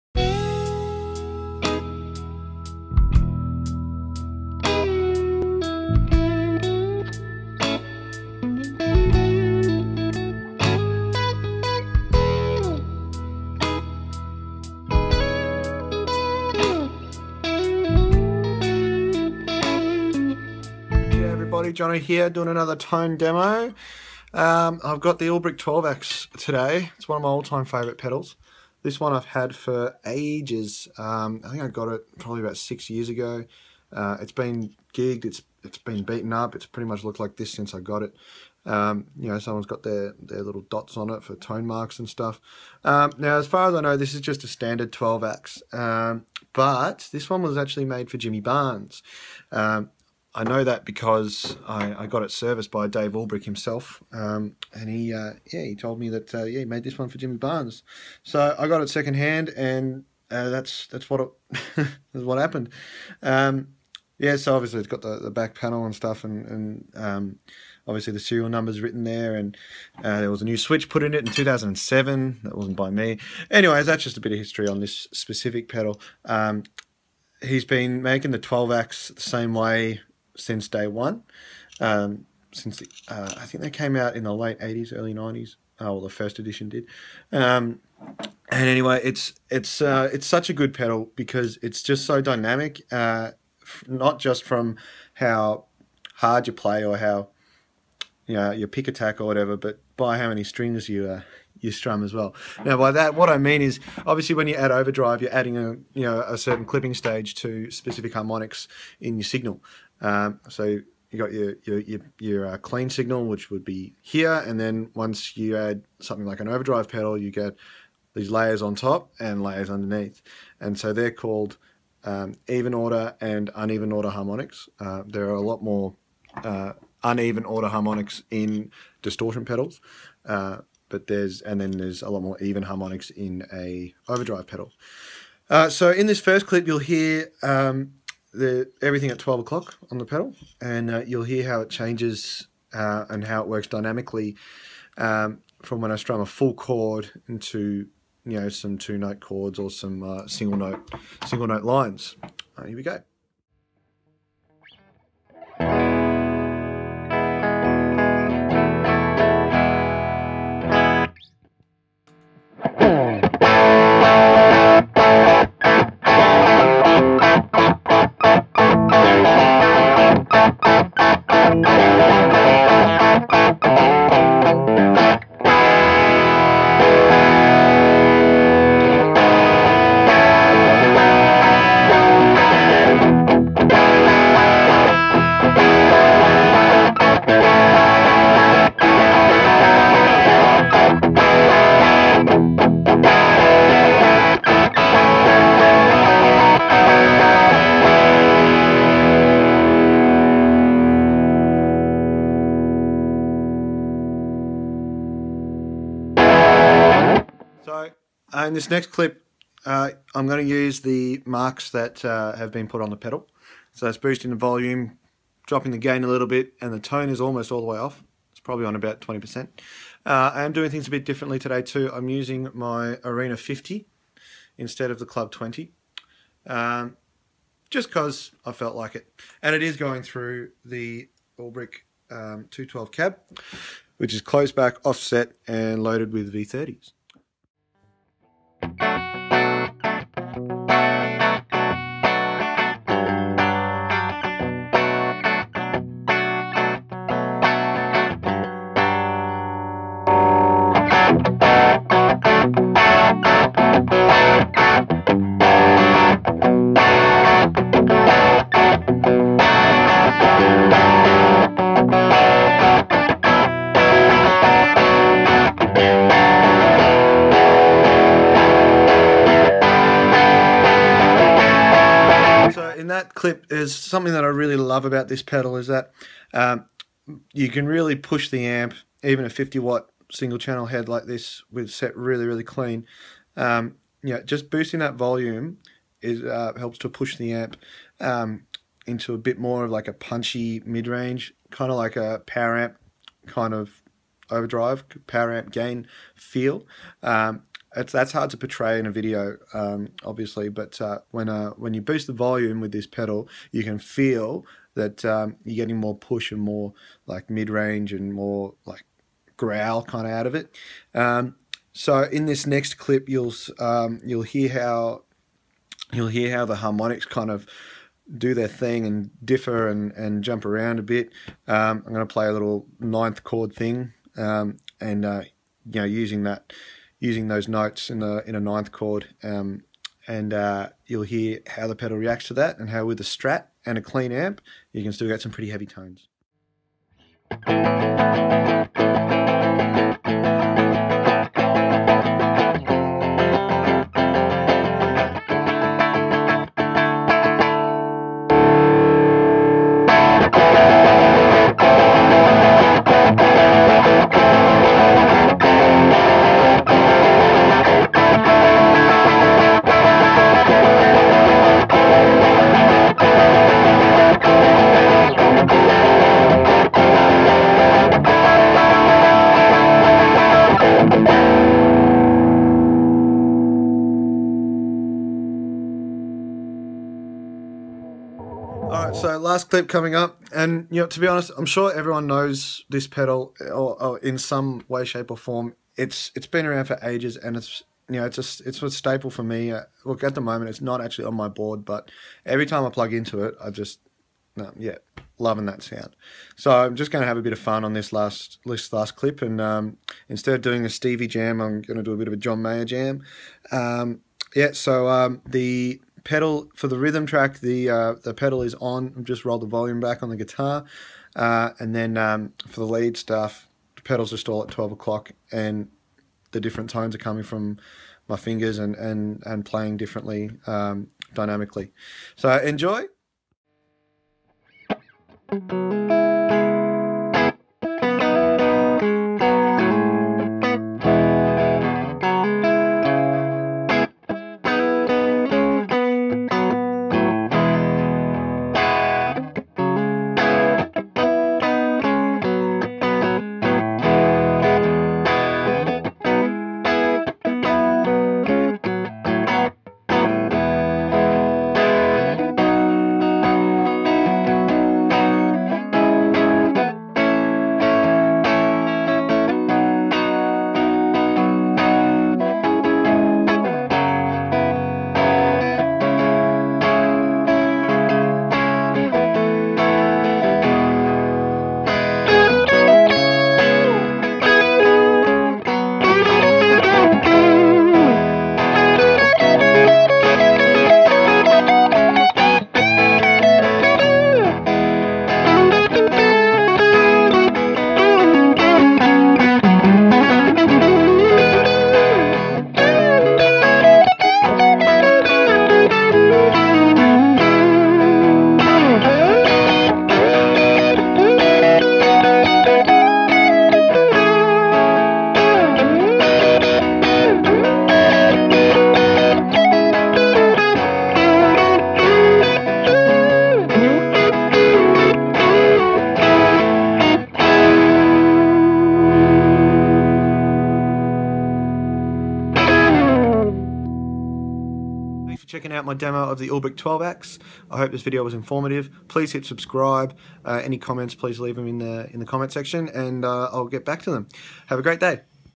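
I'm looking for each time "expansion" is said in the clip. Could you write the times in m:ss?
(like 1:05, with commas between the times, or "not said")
not said.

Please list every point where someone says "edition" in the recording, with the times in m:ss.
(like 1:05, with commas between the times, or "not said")
1:26.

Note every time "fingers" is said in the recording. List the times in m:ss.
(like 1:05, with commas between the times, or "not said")
6:58.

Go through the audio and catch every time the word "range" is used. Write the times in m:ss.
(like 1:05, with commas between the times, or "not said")
4:50, 5:07.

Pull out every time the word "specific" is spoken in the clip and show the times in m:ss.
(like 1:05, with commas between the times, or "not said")
1:15, 1:47.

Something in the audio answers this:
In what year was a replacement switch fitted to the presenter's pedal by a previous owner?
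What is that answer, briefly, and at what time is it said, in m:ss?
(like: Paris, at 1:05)
2007, at 1:11.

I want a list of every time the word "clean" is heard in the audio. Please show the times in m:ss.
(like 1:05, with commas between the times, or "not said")
1:52, 4:42, 5:33.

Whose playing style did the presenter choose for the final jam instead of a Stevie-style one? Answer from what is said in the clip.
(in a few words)
John Mayer.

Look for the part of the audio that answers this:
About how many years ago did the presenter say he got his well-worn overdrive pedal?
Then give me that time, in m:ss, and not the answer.
0:32.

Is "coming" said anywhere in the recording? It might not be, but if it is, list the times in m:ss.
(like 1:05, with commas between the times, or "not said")
6:19, 6:56.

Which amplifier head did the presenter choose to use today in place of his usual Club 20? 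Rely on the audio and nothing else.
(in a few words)
Arena 50.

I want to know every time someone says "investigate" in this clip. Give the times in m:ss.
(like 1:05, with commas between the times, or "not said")
not said.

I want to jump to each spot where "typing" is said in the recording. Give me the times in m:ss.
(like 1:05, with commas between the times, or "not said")
not said.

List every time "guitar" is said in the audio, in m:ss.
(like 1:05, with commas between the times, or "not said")
6:50.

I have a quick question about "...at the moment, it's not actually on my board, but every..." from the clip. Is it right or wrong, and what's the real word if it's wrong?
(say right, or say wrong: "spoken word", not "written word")
right.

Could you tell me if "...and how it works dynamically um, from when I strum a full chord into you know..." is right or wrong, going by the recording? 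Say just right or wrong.
right.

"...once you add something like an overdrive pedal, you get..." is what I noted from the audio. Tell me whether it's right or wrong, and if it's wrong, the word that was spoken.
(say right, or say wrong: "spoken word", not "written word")
right.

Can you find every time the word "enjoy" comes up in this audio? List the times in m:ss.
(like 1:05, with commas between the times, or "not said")
7:02.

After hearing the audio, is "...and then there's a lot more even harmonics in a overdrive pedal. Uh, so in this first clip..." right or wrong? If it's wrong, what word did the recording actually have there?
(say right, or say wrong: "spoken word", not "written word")
right.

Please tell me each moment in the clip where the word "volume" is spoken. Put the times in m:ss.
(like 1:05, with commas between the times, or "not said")
3:34, 4:44, 5:02, 6:49.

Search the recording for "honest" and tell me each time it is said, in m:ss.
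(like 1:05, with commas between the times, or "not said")
6:21.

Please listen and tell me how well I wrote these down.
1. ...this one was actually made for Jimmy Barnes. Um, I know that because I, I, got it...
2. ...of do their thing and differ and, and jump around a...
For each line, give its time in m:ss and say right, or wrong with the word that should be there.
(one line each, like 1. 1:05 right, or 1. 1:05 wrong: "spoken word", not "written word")
1. 0:47 right
2. 5:17 right.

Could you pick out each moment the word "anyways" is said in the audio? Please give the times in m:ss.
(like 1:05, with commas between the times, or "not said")
1:13, 1:28.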